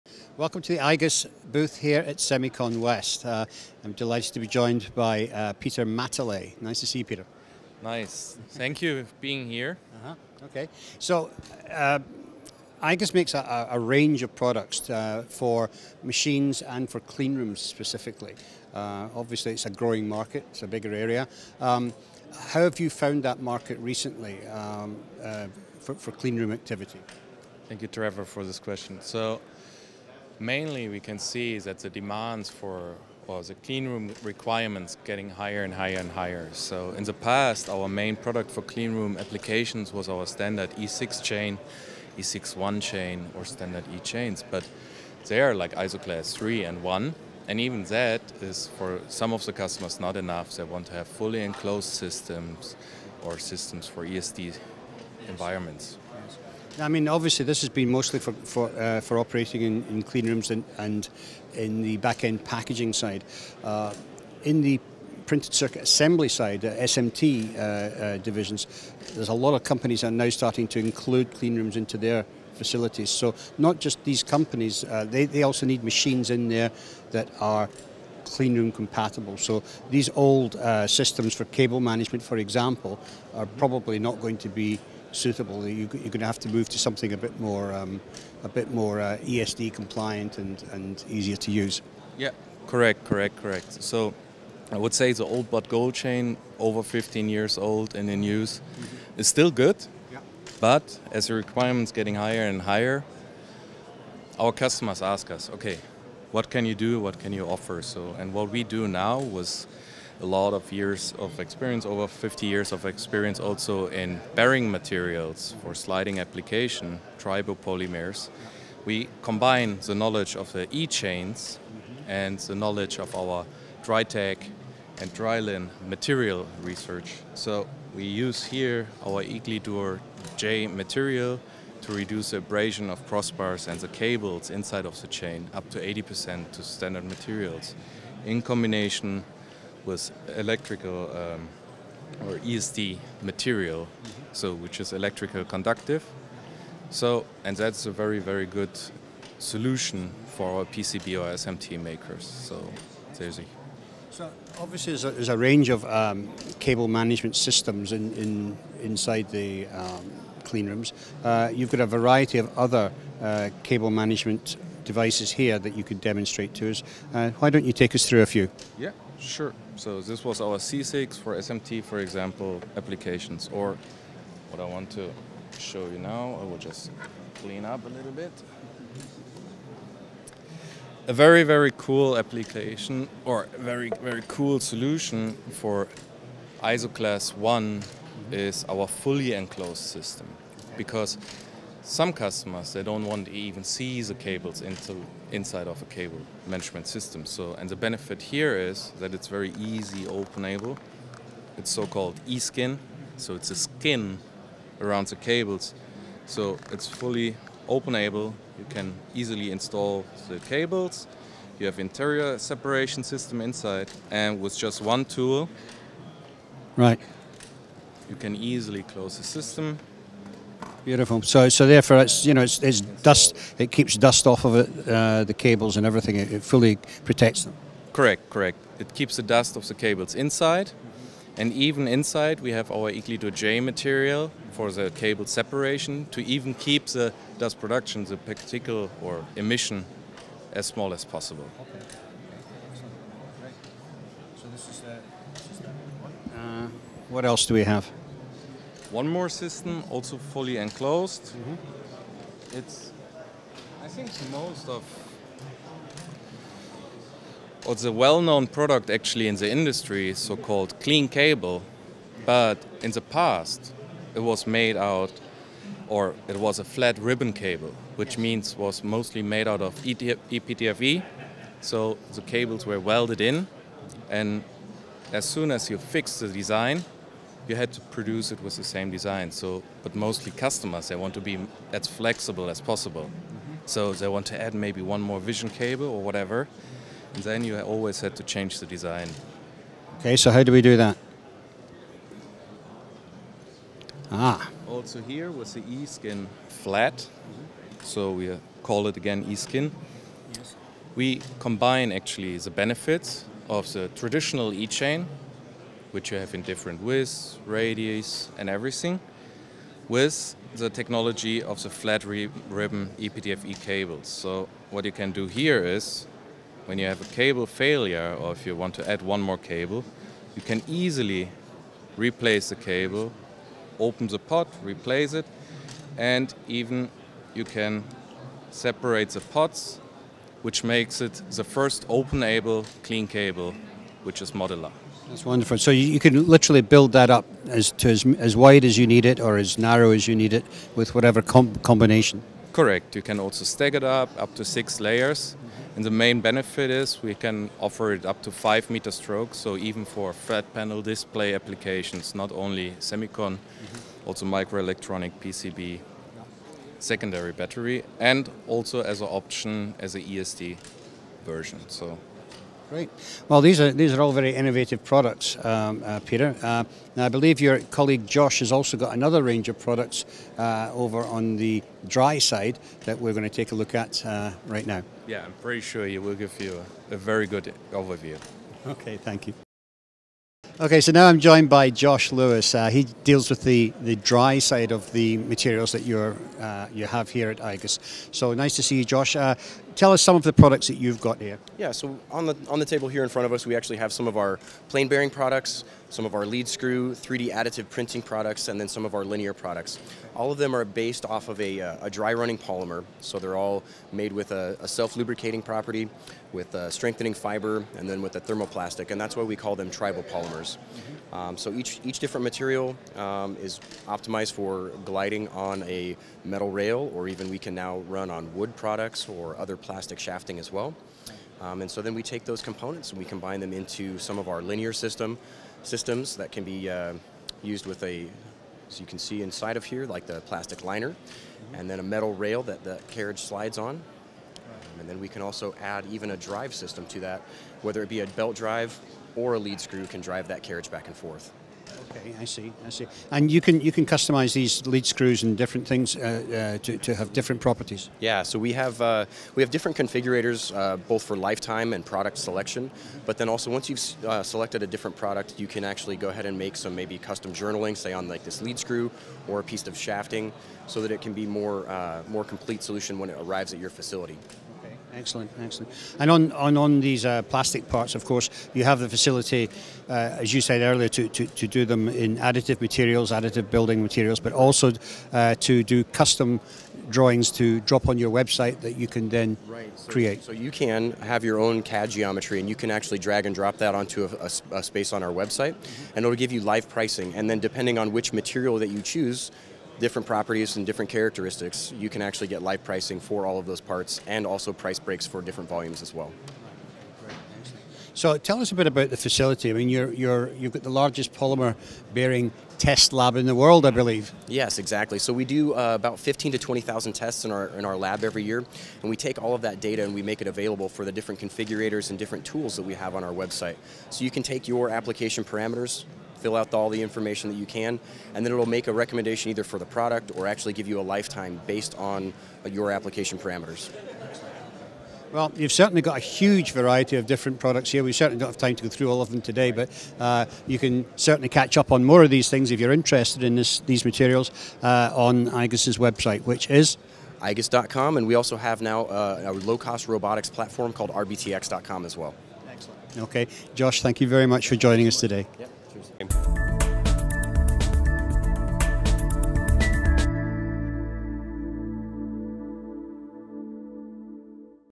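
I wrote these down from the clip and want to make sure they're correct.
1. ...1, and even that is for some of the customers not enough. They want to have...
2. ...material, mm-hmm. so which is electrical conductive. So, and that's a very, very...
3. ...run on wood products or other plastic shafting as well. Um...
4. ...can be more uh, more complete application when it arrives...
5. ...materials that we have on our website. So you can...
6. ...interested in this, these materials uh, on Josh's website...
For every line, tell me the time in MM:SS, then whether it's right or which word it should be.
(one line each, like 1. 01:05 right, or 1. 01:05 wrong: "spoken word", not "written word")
1. 00:46 right
2. 02:23 right
3. 06:57 right
4. 07:41 wrong: "solution", not "application"
5. 08:32 wrong: "tools", not "materials"
6. 08:52 wrong: "IGUS", not "Josh".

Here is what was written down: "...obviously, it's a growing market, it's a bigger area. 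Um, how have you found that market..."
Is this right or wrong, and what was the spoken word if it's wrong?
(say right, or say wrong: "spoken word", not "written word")
right.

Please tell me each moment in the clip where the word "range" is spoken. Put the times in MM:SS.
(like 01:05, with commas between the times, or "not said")
00:13, 02:35, 06:09.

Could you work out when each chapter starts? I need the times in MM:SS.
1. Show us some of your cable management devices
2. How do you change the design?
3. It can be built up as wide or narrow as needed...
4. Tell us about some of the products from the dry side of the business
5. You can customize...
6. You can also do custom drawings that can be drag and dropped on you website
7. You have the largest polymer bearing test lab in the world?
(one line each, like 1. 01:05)
1. 02:35
2. 04:50
3. 05:35
4. 06:03
5. 07:24
6. 07:45
7. 08:18.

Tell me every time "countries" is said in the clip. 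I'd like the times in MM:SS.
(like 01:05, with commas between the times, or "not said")
not said.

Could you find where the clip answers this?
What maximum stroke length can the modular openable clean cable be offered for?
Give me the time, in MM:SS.
05:48.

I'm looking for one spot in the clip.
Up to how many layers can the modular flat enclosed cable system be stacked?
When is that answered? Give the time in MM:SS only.
05:44.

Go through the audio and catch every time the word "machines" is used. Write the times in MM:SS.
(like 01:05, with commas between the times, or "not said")
00:16, 01:15.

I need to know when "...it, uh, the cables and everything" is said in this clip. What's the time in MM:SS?
03:44.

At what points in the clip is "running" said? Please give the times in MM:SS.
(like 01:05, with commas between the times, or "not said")
06:42.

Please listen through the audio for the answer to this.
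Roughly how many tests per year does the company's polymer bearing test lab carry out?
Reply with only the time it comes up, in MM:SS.
08:25.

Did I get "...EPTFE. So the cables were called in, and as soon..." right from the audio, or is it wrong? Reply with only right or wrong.
wrong.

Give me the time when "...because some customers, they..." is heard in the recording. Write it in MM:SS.
03:10.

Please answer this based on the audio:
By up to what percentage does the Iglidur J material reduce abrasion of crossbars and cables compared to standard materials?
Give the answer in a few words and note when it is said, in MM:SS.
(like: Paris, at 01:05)
80%, at 02:15.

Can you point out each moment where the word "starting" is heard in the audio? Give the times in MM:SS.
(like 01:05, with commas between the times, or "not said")
01:10.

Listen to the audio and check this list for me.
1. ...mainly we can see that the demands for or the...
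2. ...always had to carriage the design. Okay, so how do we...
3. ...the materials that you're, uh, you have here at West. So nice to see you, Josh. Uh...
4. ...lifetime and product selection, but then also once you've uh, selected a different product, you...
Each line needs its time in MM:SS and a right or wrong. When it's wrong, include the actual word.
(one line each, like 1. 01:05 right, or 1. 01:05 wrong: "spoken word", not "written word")
1. 00:30 right
2. 04:47 wrong: "change", not "carriage"
3. 06:24 wrong: "IGUS", not "West"
4. 07:31 right.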